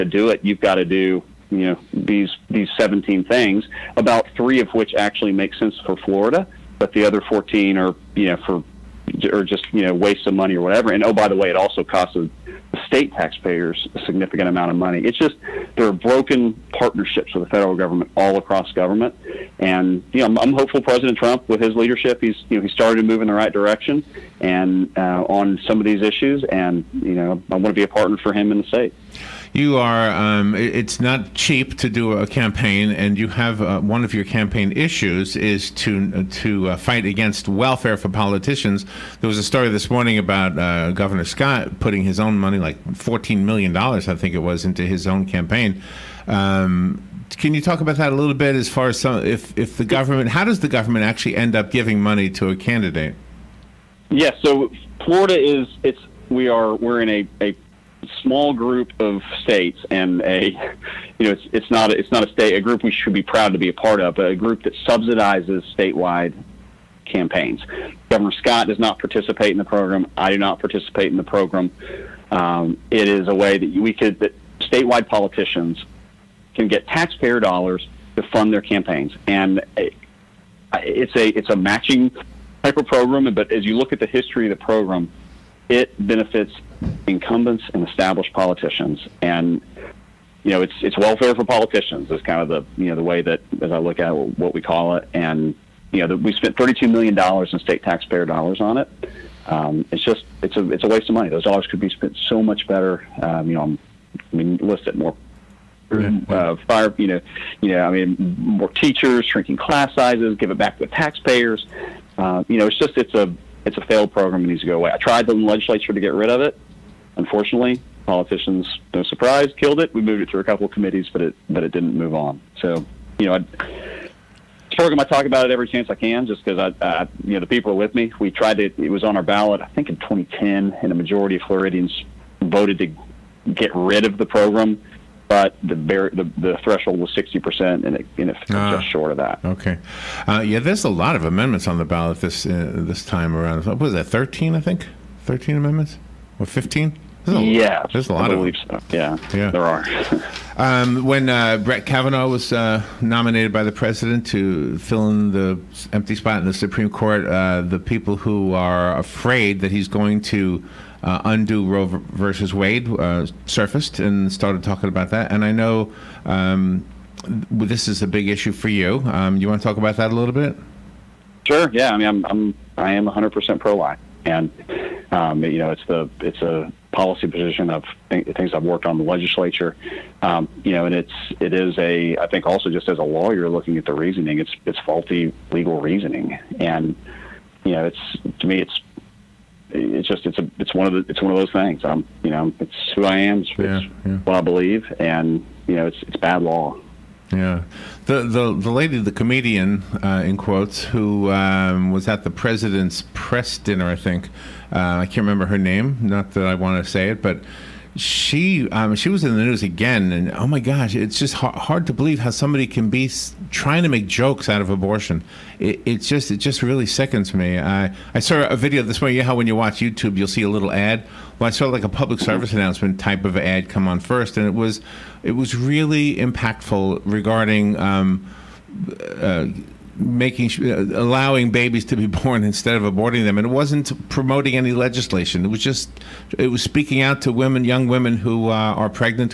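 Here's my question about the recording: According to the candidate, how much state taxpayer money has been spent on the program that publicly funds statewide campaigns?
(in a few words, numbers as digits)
$32 million.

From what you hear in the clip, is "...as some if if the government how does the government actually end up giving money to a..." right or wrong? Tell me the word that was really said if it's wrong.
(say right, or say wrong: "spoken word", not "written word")
right.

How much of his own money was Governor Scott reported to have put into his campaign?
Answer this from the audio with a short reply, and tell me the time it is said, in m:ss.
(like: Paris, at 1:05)
$14 million, at 0:42.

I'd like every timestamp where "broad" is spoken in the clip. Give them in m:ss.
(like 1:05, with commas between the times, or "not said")
not said.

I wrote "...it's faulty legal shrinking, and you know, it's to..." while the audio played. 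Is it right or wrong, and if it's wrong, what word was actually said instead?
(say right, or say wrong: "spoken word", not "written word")
wrong: "reasoning", not "shrinking".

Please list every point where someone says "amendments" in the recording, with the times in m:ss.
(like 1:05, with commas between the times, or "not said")
2:21, 2:25.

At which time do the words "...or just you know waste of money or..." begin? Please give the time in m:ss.
0:09.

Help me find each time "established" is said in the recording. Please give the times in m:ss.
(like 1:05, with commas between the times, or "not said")
1:27.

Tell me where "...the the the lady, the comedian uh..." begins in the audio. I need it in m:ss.
3:18.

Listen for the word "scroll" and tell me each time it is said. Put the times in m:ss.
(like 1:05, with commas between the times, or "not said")
not said.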